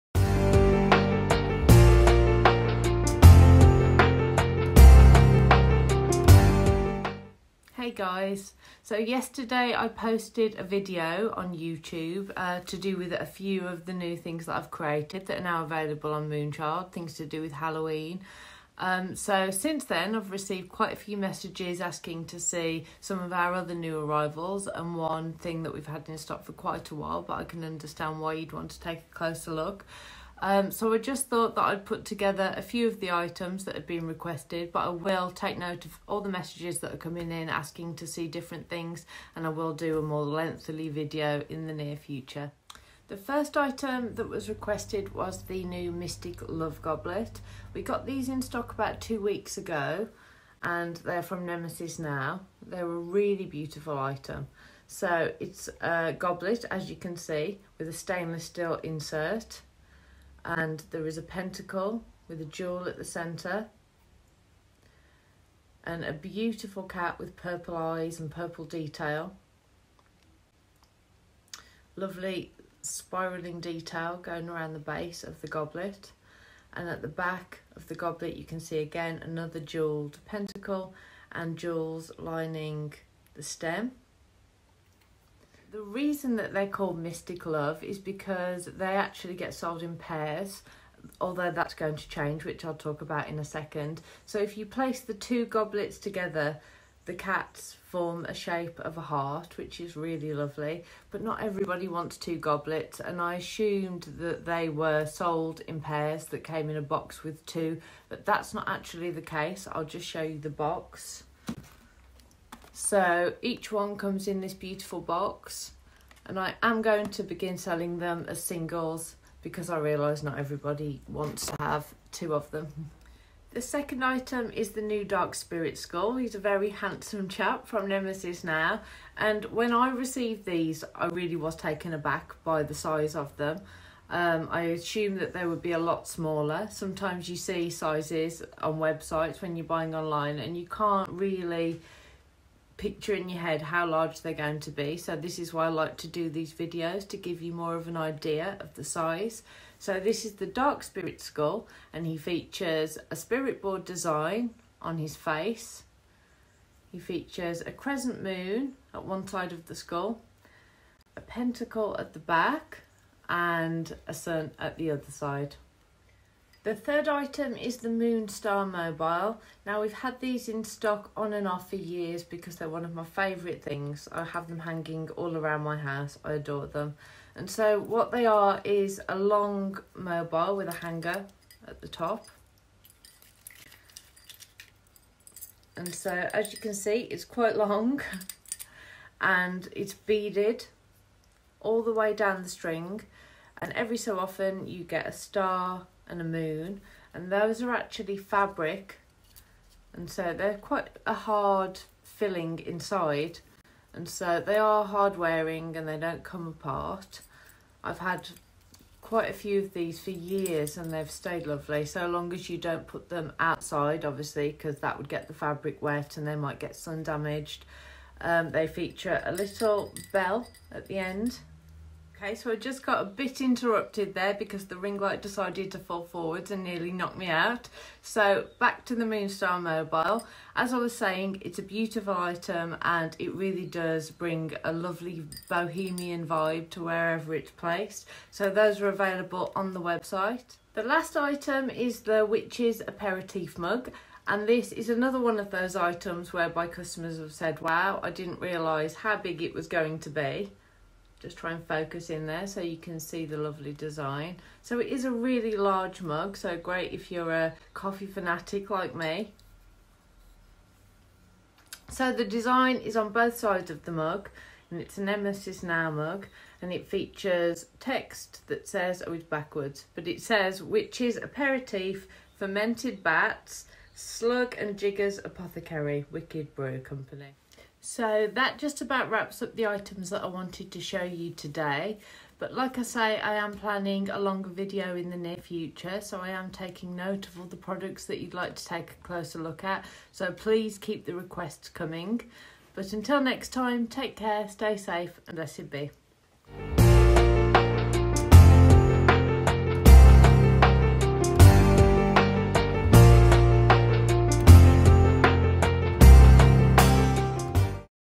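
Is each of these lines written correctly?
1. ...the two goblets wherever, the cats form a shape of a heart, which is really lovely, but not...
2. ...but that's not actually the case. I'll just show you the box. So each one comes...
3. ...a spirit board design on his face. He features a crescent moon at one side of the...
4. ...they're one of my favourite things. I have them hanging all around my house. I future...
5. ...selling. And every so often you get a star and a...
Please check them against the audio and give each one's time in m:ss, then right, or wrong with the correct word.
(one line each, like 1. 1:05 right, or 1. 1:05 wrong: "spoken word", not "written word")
1. 1:34 wrong: "together", not "wherever"
2. 1:48 right
3. 2:33 right
4. 2:52 wrong: "adore", not "future"
5. 3:12 wrong: "string", not "selling".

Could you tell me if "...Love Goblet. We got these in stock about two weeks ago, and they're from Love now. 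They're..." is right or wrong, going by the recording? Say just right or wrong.
wrong.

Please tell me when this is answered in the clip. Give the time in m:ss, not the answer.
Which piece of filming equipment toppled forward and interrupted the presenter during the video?
3:44.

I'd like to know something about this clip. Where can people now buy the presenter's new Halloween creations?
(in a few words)
Moonchild.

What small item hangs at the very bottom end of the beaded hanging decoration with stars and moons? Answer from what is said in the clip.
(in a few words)
A little bell.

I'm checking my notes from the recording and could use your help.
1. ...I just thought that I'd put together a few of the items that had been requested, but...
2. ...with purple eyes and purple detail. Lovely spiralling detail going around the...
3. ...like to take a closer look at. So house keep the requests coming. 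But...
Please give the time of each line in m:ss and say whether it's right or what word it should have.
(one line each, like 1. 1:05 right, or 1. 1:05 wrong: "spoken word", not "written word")
1. 0:30 right
2. 1:07 right
3. 4:48 wrong: "please", not "house".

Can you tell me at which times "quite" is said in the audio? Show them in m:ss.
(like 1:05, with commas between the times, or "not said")
0:20, 0:26, 3:07, 3:20, 3:29.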